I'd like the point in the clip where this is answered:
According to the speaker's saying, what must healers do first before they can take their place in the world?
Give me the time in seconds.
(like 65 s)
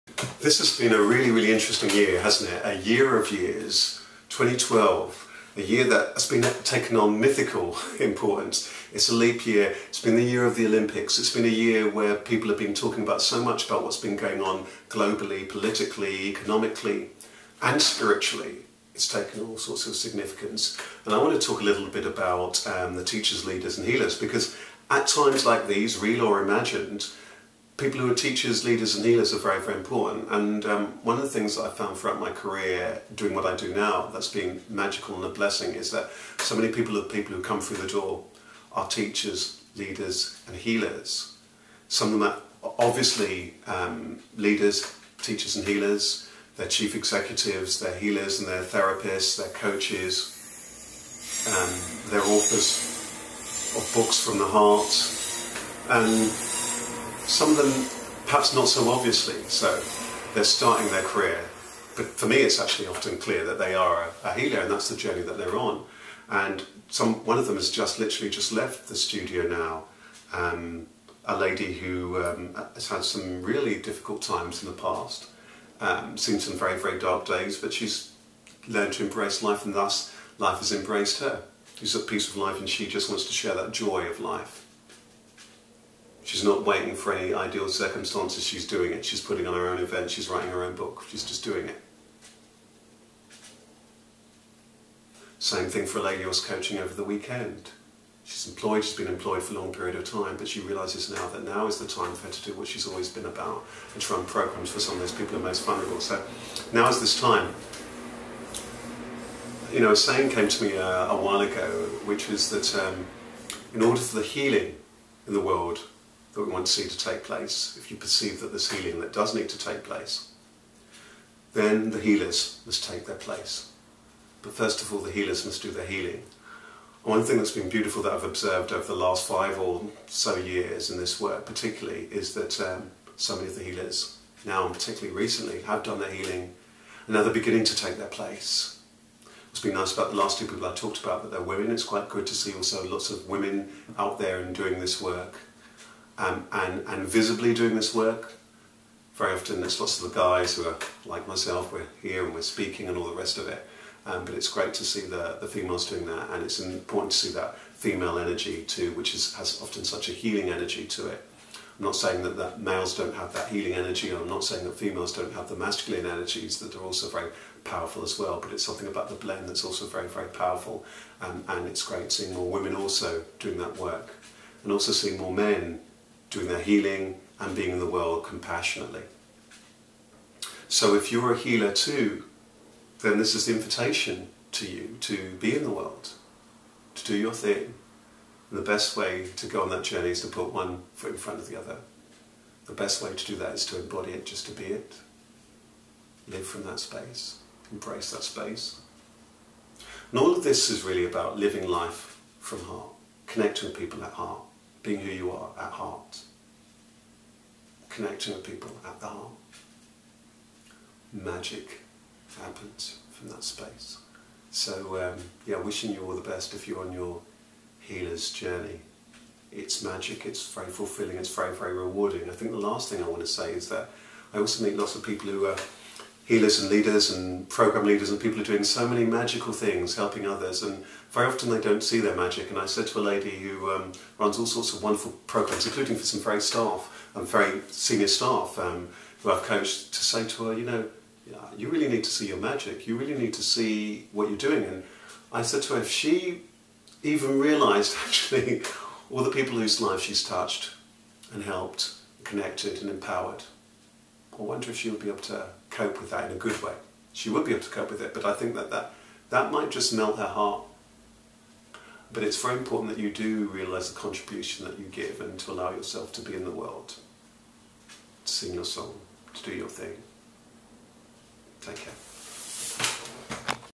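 125 s.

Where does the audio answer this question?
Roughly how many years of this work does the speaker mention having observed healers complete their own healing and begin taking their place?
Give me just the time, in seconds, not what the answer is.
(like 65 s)
129 s.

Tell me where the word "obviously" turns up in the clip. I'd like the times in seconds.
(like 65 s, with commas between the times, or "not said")
42 s, 58 s.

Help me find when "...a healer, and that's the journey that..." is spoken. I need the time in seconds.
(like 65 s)
64 s.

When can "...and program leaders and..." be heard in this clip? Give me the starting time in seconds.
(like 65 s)
227 s.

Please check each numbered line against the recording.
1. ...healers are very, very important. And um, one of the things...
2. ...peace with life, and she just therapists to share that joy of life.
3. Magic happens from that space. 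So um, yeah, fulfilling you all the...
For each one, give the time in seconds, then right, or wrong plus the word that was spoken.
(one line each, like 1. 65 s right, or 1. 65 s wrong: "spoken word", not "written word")
1. 29 s right
2. 82 s wrong: "wants", not "therapists"
3. 211 s wrong: "wishing", not "fulfilling".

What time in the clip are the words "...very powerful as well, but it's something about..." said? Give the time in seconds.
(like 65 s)
167 s.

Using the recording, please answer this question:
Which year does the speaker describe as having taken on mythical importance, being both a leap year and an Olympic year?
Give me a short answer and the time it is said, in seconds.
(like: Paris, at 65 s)
2012, at 4 s.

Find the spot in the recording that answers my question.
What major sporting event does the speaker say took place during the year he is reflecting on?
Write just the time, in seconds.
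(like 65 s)
10 s.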